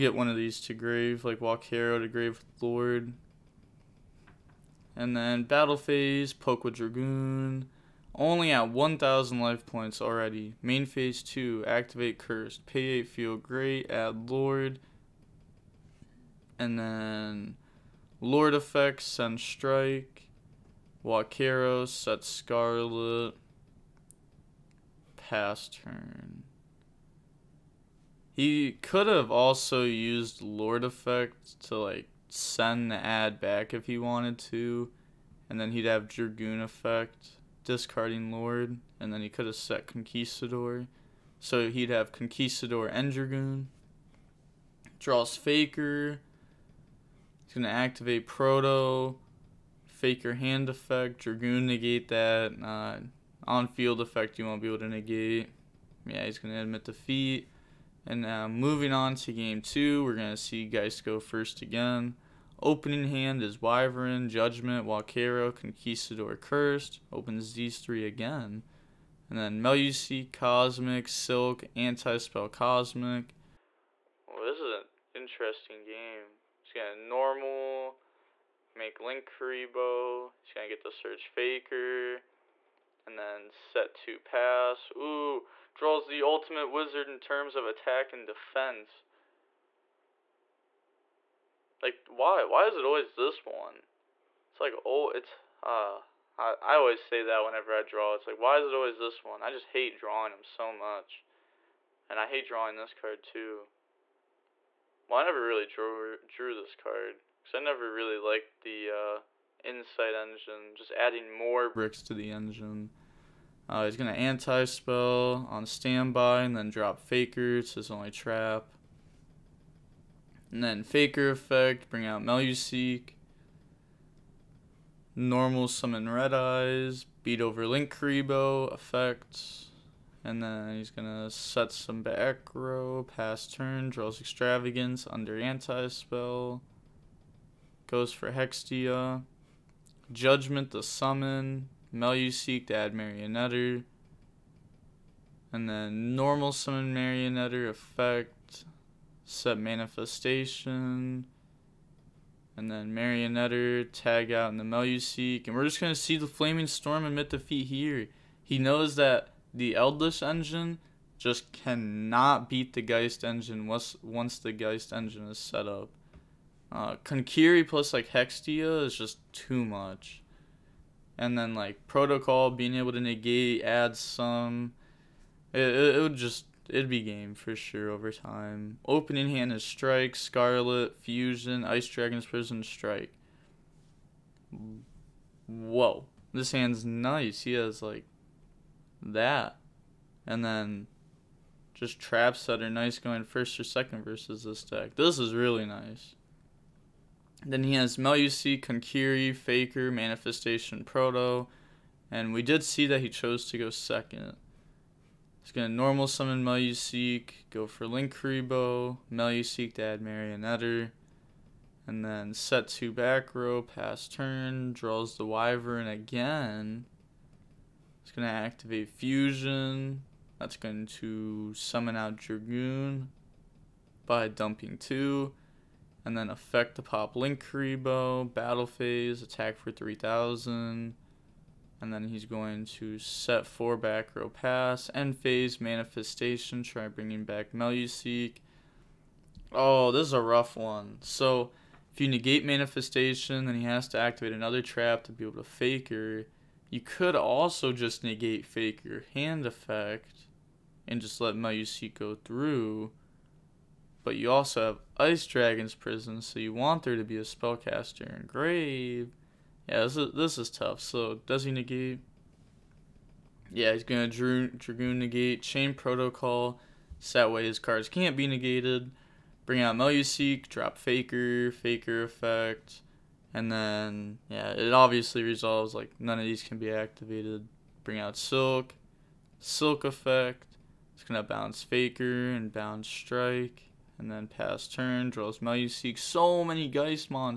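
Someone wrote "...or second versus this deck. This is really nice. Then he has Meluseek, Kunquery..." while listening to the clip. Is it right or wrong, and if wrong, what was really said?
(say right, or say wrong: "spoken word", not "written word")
right.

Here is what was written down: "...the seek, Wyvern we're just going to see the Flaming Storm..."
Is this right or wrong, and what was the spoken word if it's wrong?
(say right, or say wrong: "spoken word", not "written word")
wrong: "And", not "Wyvern".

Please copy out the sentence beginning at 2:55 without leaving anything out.
It, it, it would just it'd be game for sure over time.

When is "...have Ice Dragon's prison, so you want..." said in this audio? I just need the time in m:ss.
4:14.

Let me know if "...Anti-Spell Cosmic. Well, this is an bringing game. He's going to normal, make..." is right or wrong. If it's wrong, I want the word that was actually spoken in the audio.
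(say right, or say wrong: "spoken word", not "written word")
wrong: "interesting", not "bringing".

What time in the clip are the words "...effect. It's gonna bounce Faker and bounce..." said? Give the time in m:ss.
4:39.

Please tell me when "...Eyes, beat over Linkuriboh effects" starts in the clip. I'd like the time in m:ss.
2:06.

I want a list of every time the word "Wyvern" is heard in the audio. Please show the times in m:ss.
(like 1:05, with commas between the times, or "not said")
1:03, 3:35.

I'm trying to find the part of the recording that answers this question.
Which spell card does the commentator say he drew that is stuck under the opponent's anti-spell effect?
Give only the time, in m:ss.
2:14.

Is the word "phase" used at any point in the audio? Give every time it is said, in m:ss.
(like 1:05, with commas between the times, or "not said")
0:05, 0:10, 3:48, 3:55.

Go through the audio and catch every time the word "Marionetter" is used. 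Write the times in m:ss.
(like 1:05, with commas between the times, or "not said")
2:22, 2:26, 2:32, 3:29.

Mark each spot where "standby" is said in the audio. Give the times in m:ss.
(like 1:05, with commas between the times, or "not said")
1:55.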